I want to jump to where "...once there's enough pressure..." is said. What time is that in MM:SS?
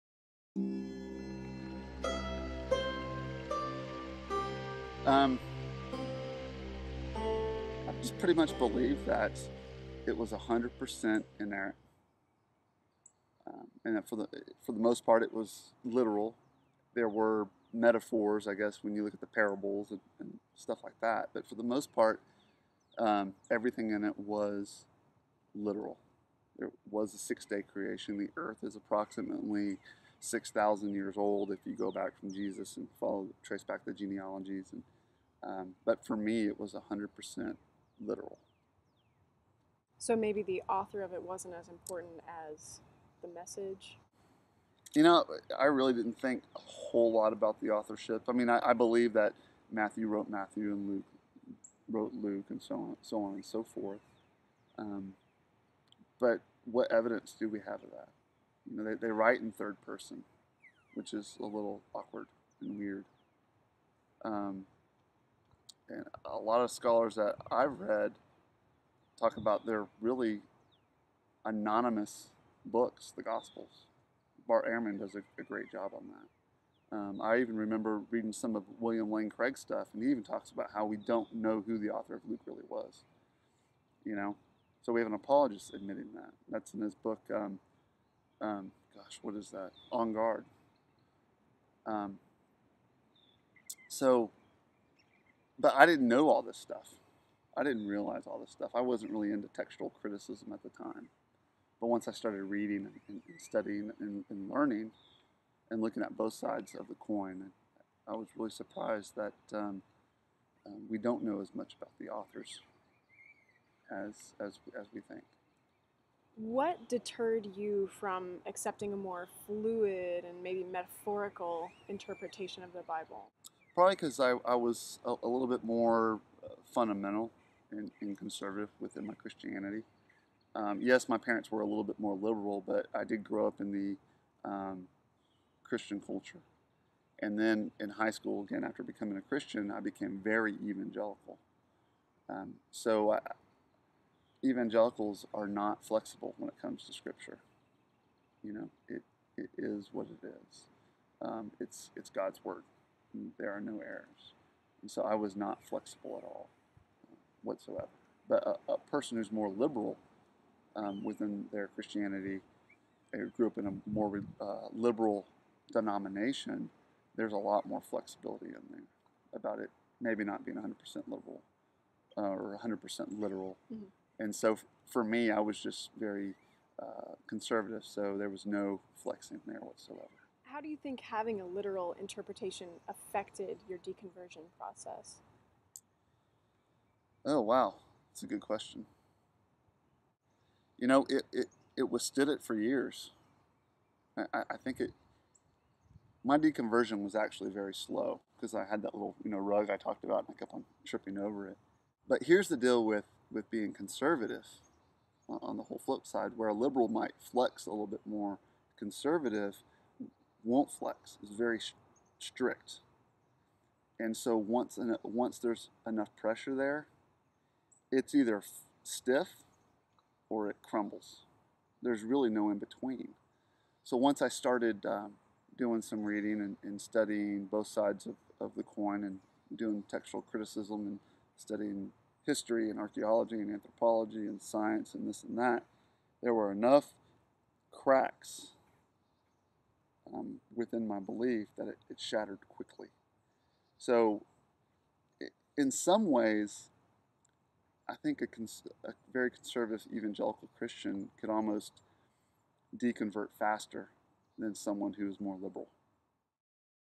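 03:35.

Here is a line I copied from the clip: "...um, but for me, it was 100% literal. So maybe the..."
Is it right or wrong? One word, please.
right.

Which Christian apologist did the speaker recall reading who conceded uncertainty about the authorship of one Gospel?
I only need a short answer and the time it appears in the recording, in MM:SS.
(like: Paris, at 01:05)
William Lane Craig, at 01:18.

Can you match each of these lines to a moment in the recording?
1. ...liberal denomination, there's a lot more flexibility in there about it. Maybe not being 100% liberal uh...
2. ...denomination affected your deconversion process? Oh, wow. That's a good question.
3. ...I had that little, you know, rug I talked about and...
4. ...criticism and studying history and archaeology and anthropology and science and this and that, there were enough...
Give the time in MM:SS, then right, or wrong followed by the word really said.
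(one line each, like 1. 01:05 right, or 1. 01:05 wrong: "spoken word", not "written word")
1. 02:44 right
2. 03:01 wrong: "interpretation", not "denomination"
3. 03:18 right
4. 03:50 right.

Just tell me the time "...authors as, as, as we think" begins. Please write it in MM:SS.
01:52.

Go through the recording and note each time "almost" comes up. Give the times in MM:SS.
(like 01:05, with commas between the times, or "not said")
04:11.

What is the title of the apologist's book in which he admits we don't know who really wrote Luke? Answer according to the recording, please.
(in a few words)
On Guard.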